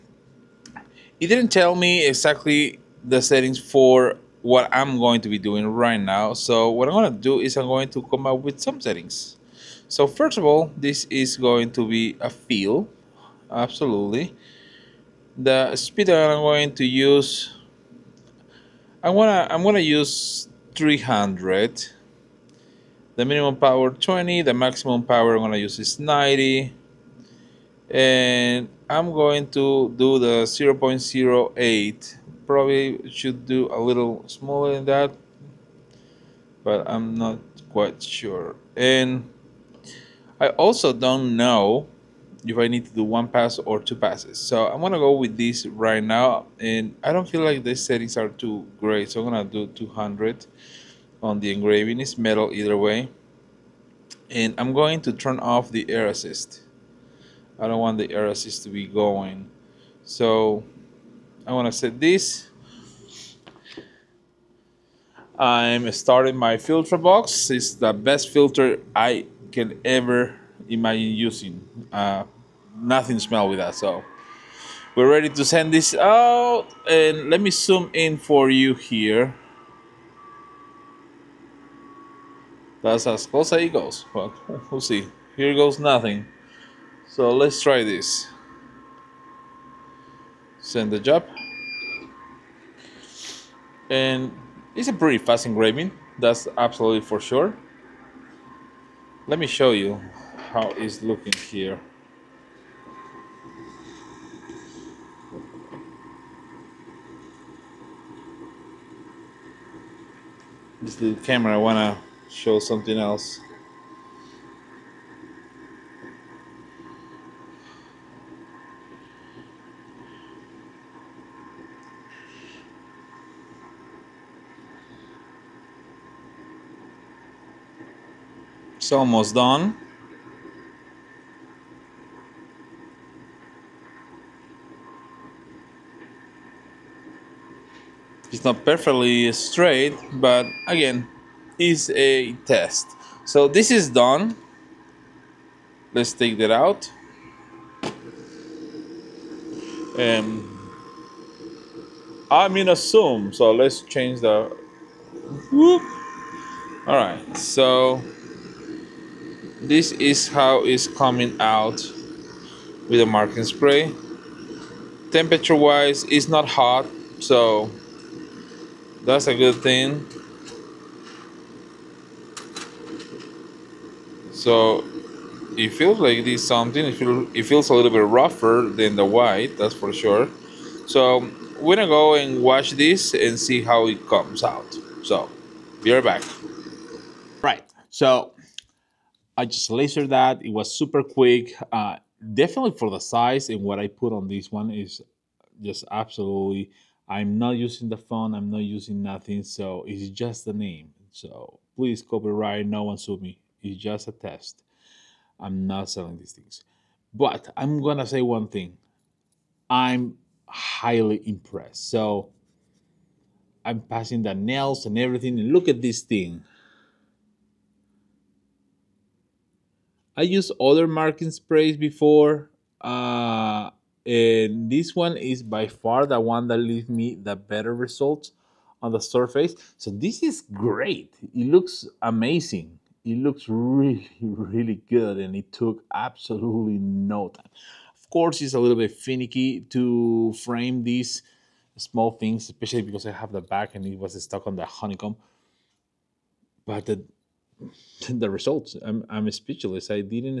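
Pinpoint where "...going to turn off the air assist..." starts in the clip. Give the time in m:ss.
0:54.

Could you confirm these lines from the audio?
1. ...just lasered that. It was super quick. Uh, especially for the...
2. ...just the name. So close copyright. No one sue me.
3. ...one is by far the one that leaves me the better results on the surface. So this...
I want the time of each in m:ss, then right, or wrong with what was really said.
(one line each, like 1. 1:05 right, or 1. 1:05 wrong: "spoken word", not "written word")
1. 3:09 wrong: "definitely", not "especially"
2. 3:20 wrong: "please", not "close"
3. 3:44 right.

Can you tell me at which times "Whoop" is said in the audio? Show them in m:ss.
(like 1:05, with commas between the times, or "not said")
2:35.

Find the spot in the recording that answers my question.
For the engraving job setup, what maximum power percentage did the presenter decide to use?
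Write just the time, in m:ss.
0:25.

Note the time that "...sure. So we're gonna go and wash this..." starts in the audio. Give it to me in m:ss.
2:59.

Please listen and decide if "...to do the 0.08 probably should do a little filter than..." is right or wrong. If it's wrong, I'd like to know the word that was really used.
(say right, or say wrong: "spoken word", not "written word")
wrong: "smaller", not "filter".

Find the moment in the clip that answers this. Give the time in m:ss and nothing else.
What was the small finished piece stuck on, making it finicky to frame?
4:04.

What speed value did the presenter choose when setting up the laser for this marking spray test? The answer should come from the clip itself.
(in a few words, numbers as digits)
300.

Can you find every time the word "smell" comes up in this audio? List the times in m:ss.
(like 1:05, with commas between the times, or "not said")
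1:13.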